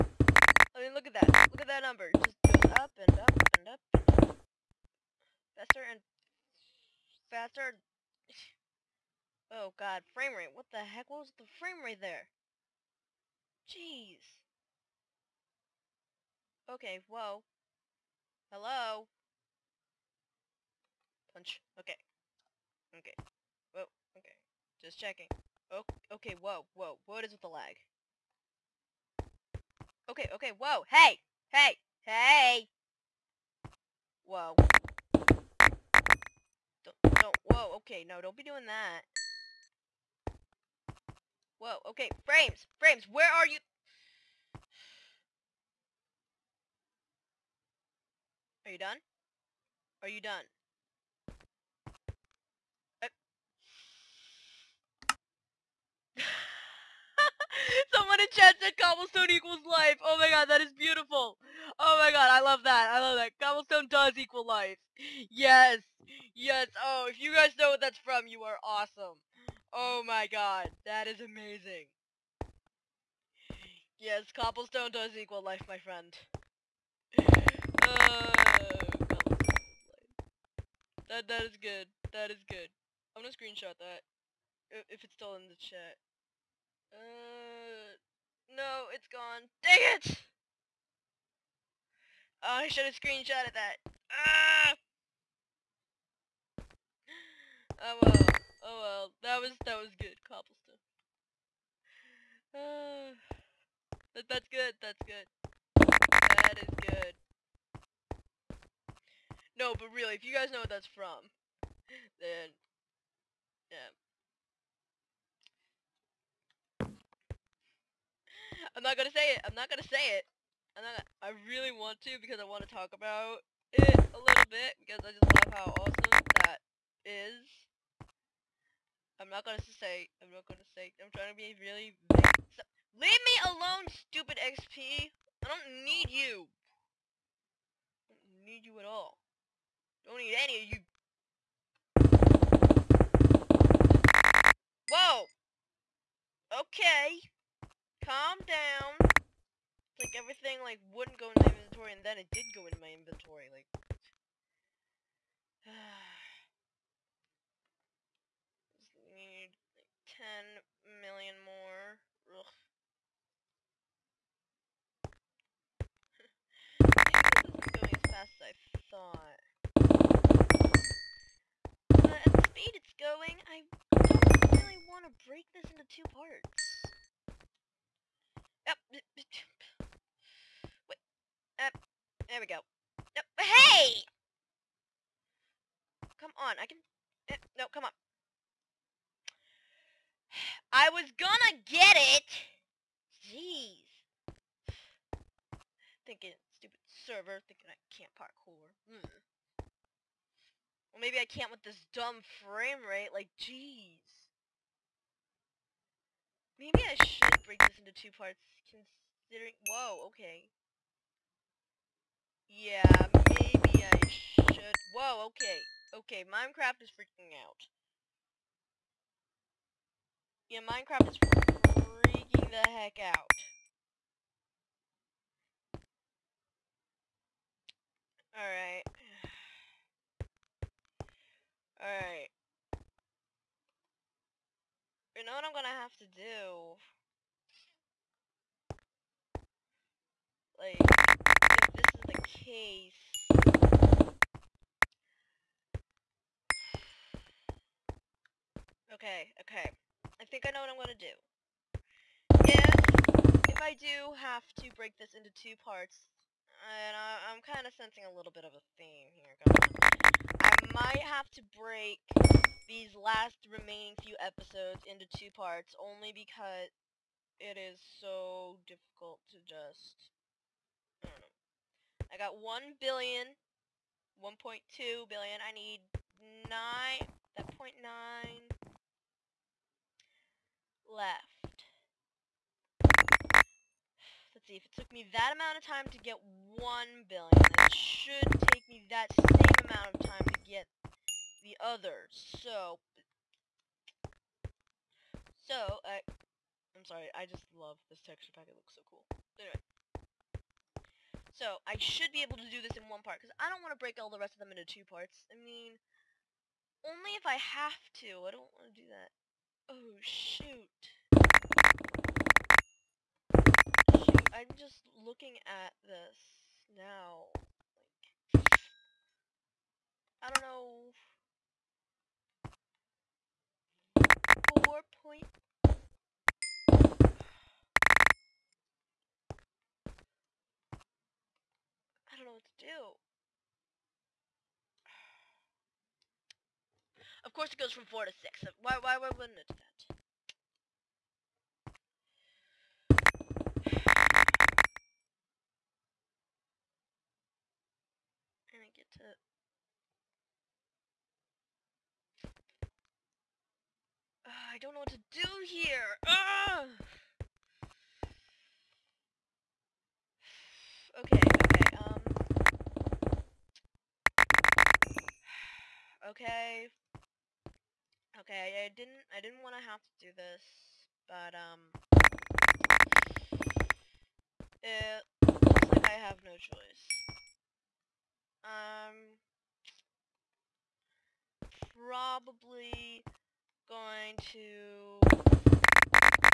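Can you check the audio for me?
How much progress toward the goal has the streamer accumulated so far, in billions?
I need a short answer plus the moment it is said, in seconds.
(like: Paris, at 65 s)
1.2 billion, at 274 s.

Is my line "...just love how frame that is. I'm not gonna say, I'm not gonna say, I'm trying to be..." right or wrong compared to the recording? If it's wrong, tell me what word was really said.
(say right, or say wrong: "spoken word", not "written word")
wrong: "awesome", not "frame".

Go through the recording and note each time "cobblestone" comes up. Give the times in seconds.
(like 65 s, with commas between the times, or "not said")
58 s, 63 s, 74 s, 100 s.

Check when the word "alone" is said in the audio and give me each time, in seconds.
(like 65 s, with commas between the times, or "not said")
133 s.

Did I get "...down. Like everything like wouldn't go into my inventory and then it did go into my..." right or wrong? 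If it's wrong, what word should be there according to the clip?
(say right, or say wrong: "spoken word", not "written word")
right.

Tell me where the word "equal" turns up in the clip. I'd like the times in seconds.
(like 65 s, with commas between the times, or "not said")
59 s, 64 s, 75 s.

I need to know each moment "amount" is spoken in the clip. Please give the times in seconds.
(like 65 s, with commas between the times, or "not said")
285 s, 289 s.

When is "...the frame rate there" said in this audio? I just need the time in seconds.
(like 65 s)
11 s.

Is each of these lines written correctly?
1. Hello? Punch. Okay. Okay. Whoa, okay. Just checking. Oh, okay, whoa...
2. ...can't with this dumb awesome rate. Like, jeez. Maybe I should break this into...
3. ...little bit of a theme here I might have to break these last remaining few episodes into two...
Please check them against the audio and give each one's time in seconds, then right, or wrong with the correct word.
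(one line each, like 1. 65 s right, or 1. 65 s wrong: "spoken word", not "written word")
1. 18 s right
2. 201 s wrong: "frame", not "awesome"
3. 258 s right.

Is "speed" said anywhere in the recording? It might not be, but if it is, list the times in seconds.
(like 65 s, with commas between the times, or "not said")
172 s.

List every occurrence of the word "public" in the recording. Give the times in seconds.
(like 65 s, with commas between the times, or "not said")
not said.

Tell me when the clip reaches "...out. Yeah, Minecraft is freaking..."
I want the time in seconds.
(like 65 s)
217 s.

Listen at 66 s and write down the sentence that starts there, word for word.
Oh, if you guys know what that's from, you are awesome.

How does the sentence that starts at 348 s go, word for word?
to uh, I don't know what to do here.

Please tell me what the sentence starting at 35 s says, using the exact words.
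Don't, don't, whoa, okay, no, don't be doing that.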